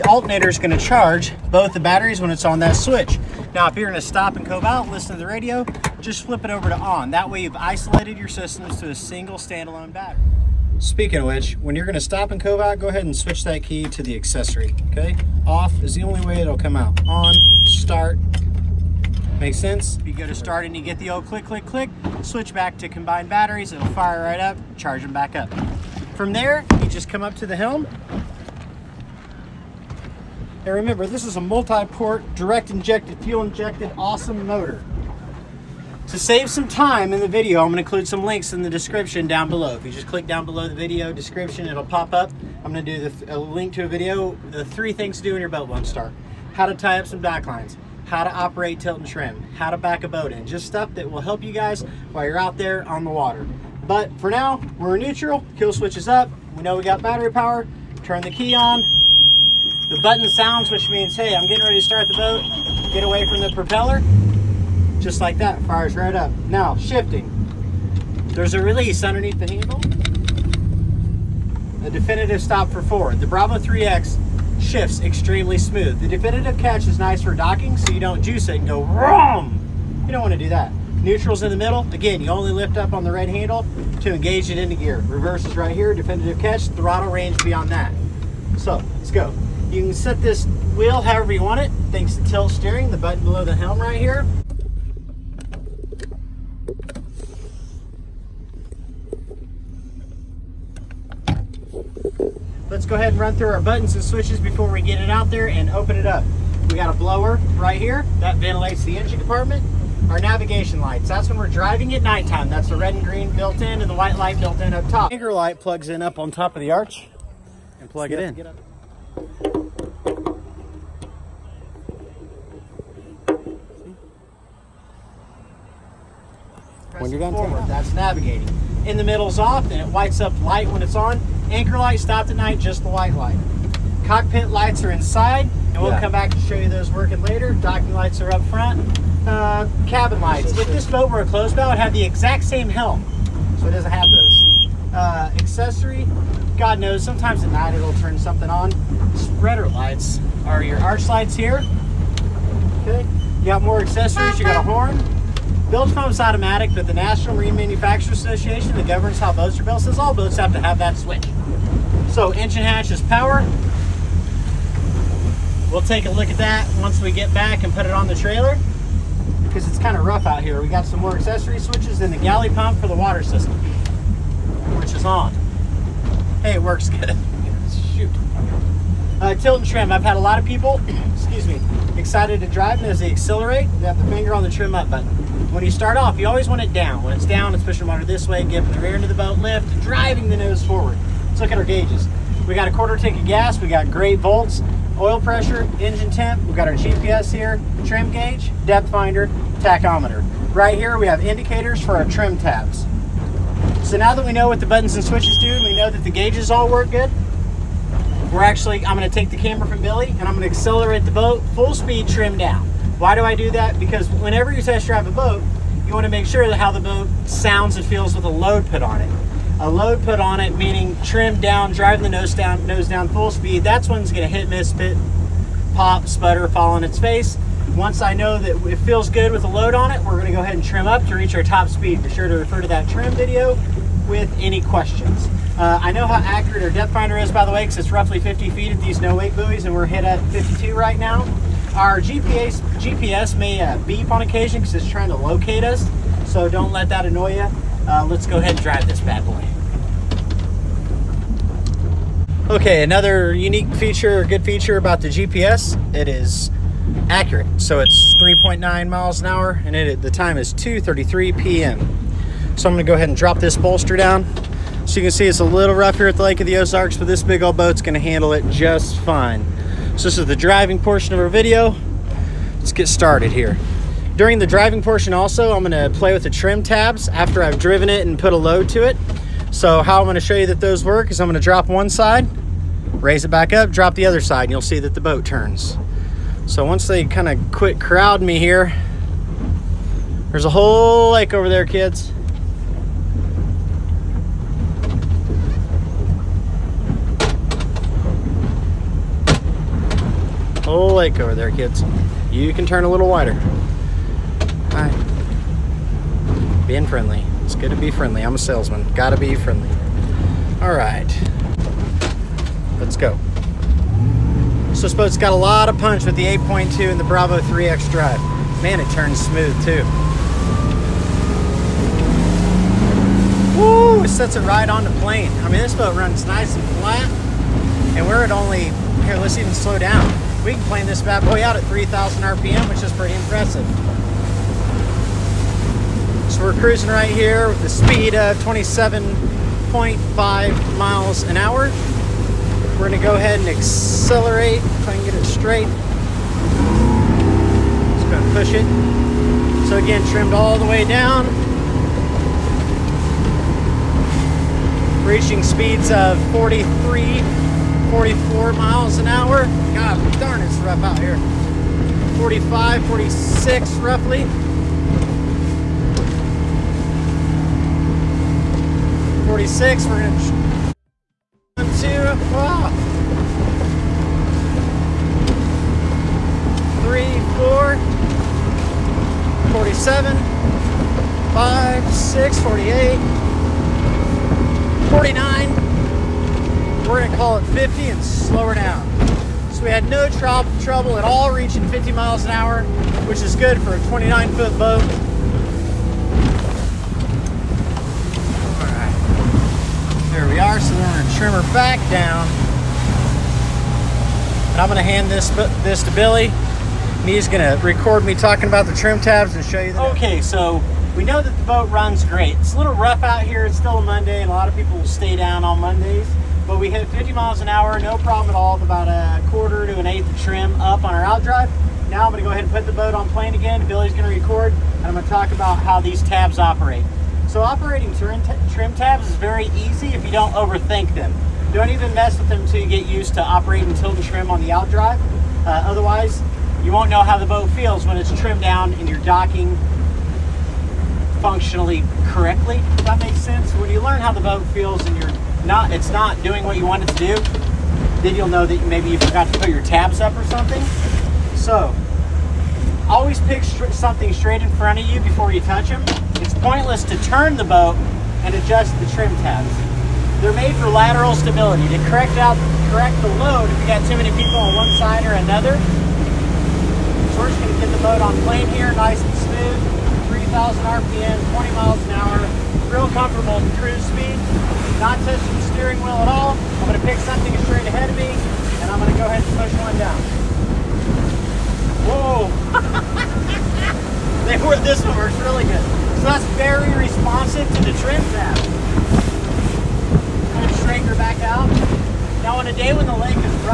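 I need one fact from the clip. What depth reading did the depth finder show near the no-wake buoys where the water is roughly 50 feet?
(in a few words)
52.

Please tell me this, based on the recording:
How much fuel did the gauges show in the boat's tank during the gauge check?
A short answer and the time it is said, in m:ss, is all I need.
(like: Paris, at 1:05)
A quarter tank, at 3:12.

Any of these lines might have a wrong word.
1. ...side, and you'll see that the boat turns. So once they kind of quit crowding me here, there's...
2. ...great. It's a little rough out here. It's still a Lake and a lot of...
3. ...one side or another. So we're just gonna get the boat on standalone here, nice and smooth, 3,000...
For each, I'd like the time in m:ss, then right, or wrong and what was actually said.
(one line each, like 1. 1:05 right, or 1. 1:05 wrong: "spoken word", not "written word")
1. 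4:44 right
2. 6:52 wrong: "Monday", not "Lake"
3. 7:44 wrong: "plane", not "standalone".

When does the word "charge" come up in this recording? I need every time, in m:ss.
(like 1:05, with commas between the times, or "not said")
0:00, 0:24.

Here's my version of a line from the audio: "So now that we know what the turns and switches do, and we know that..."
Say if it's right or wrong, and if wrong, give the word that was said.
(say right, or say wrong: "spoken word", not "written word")
wrong: "buttons", not "turns".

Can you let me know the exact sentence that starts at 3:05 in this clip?
When you start off, you always want it down.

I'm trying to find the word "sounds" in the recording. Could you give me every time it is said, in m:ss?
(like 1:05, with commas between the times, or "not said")
1:00, 3:37.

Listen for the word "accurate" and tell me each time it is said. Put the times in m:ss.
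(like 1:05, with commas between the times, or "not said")
3:56, 4:17.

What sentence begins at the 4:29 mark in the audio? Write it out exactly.
So this is the driving portion of our video.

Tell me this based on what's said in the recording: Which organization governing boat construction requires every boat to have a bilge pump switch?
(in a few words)
National Marine Manufacturers Association.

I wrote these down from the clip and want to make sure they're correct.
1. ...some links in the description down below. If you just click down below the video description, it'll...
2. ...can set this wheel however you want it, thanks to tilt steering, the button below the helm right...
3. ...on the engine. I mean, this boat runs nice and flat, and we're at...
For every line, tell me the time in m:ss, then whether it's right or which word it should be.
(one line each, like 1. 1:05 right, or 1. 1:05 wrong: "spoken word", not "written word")
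1. 0:38 right
2. 1:29 right
3. 5:24 wrong: "plane", not "engine".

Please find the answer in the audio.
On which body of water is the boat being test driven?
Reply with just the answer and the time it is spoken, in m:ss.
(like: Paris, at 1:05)
Lake of the Ozarks, at 4:26.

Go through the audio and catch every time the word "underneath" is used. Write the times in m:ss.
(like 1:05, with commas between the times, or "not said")
1:09.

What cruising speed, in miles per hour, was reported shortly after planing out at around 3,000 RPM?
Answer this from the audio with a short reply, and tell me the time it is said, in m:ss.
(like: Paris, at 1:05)
27.5, at 5:38.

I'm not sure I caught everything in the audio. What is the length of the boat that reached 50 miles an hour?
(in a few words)
29 feet.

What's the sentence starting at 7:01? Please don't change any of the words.
Now I'm gonna go ahead and put the boat on plane again.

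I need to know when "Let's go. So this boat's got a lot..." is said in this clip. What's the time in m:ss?
5:12.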